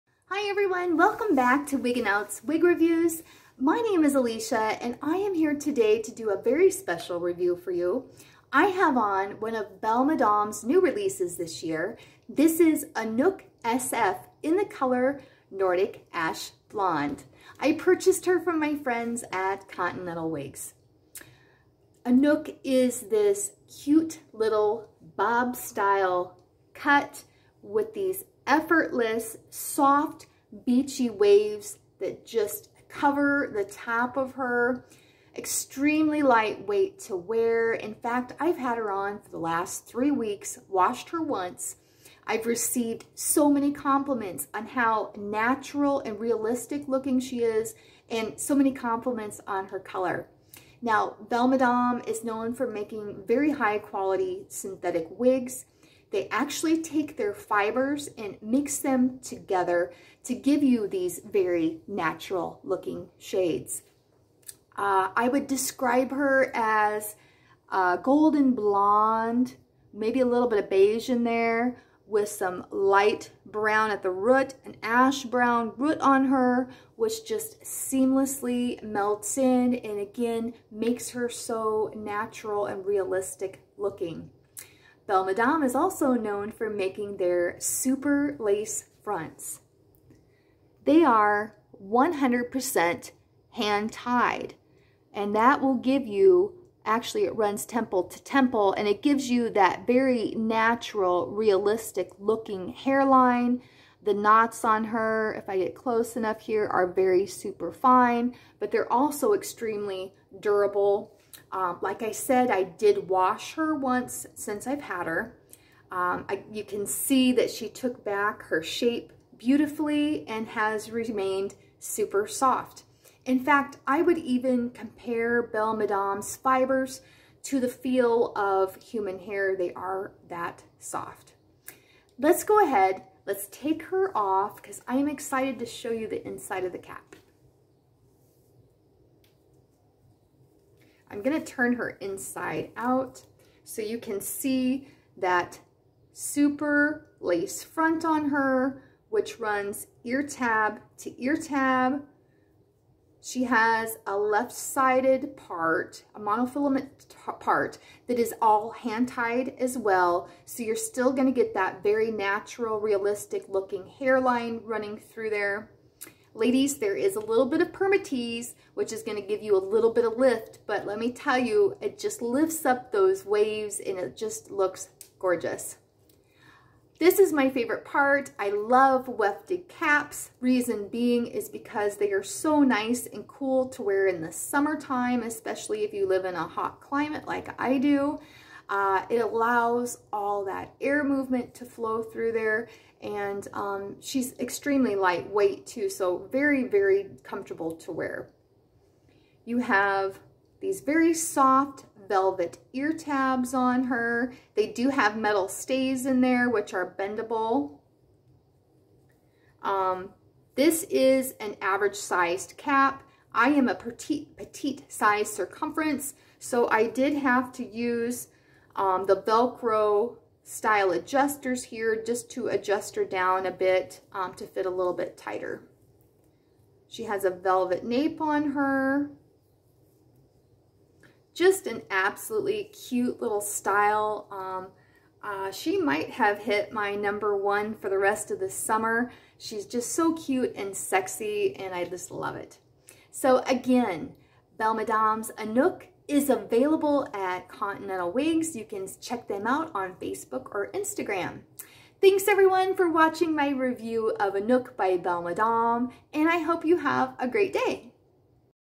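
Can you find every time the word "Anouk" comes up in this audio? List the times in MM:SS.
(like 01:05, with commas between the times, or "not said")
00:12, 00:22, 04:05, 04:14.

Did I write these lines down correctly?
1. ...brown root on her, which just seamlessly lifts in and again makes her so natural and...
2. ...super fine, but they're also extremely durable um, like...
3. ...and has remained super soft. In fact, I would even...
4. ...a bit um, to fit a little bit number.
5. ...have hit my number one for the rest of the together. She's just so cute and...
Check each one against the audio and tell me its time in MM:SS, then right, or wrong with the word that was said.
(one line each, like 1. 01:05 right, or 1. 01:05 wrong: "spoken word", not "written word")
1. 01:15 wrong: "melts", not "lifts"
2. 01:47 right
3. 02:00 right
4. 03:43 wrong: "tighter", not "number"
5. 03:56 wrong: "summer", not "together".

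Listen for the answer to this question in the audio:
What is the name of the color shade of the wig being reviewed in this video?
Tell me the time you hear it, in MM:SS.
00:15.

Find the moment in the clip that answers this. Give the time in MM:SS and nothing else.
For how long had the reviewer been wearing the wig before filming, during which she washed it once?
00:39.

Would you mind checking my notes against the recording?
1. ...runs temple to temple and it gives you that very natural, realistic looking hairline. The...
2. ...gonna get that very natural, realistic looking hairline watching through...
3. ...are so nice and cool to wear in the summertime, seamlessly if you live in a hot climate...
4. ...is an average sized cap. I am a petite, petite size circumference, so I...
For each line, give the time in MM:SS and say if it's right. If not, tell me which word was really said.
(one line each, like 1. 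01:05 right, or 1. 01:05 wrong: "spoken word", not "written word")
1. 01:37 right
2. 02:41 wrong: "running", not "watching"
3. 03:02 wrong: "especially", not "seamlessly"
4. 03:30 right.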